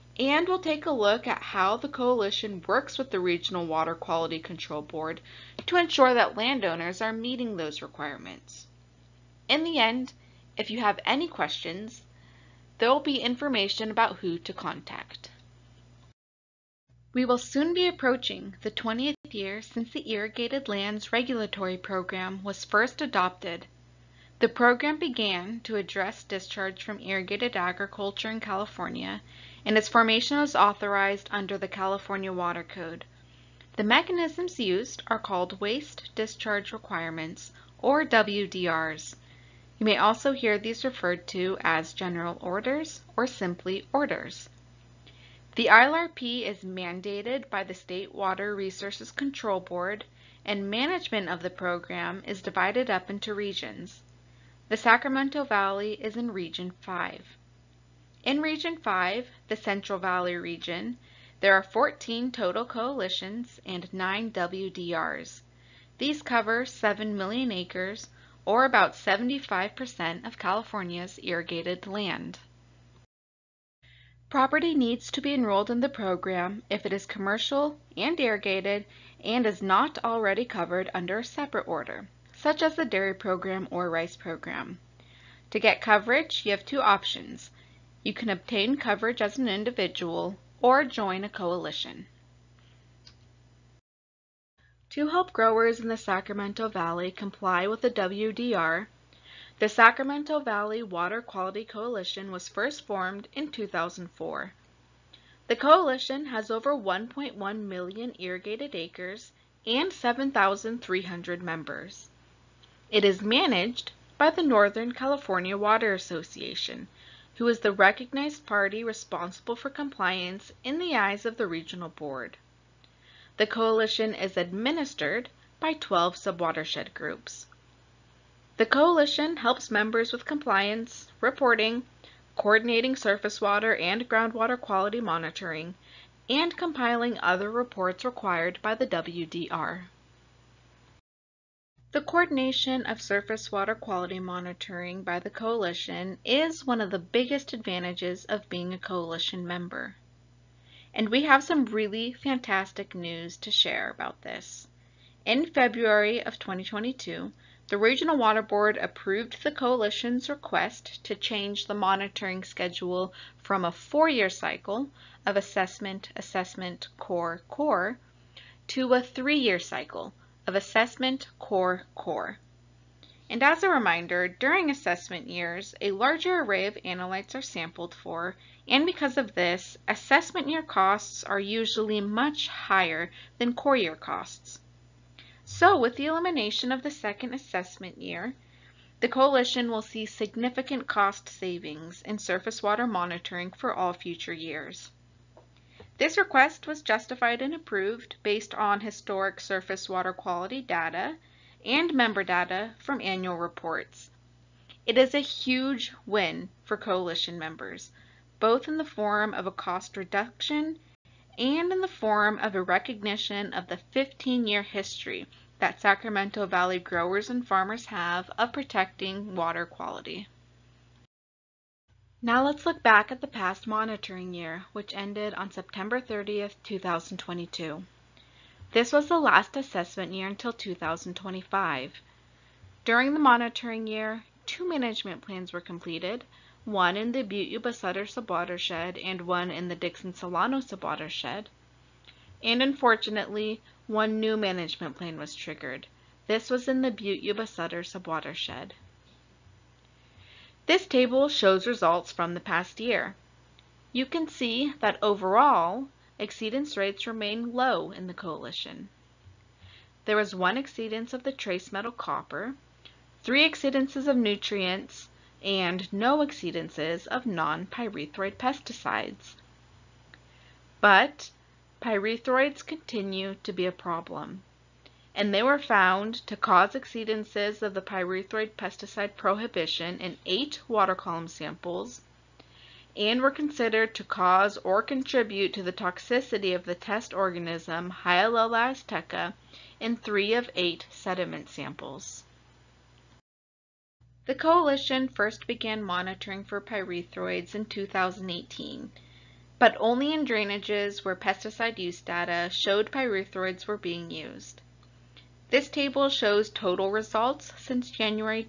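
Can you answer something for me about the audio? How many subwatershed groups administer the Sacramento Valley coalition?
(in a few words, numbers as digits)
12.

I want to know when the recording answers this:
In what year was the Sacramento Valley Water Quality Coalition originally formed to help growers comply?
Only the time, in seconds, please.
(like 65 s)
103 s.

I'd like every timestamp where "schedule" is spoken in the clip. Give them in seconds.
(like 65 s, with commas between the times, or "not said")
162 s.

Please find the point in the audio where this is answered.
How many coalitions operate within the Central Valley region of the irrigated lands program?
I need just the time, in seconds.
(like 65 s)
61 s.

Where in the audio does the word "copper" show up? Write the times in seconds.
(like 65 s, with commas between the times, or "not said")
261 s.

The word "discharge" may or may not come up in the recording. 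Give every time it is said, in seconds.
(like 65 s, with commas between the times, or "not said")
26 s, 36 s.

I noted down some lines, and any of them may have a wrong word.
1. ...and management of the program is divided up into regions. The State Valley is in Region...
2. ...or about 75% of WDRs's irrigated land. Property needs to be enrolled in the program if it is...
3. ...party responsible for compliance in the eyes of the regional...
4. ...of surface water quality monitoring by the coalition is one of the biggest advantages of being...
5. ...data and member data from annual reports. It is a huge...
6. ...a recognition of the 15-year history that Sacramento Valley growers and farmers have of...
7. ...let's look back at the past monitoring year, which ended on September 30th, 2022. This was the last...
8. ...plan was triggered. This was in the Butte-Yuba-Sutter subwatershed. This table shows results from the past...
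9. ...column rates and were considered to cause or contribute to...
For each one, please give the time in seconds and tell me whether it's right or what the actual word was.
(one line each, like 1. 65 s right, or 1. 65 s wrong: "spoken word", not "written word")
1. 50 s wrong: "Sacramento", not "State"
2. 68 s wrong: "California", not "WDRs"
3. 118 s right
4. 142 s right
5. 200 s right
6. 212 s right
7. 222 s right
8. 244 s right
9. 280 s wrong: "samples", not "rates".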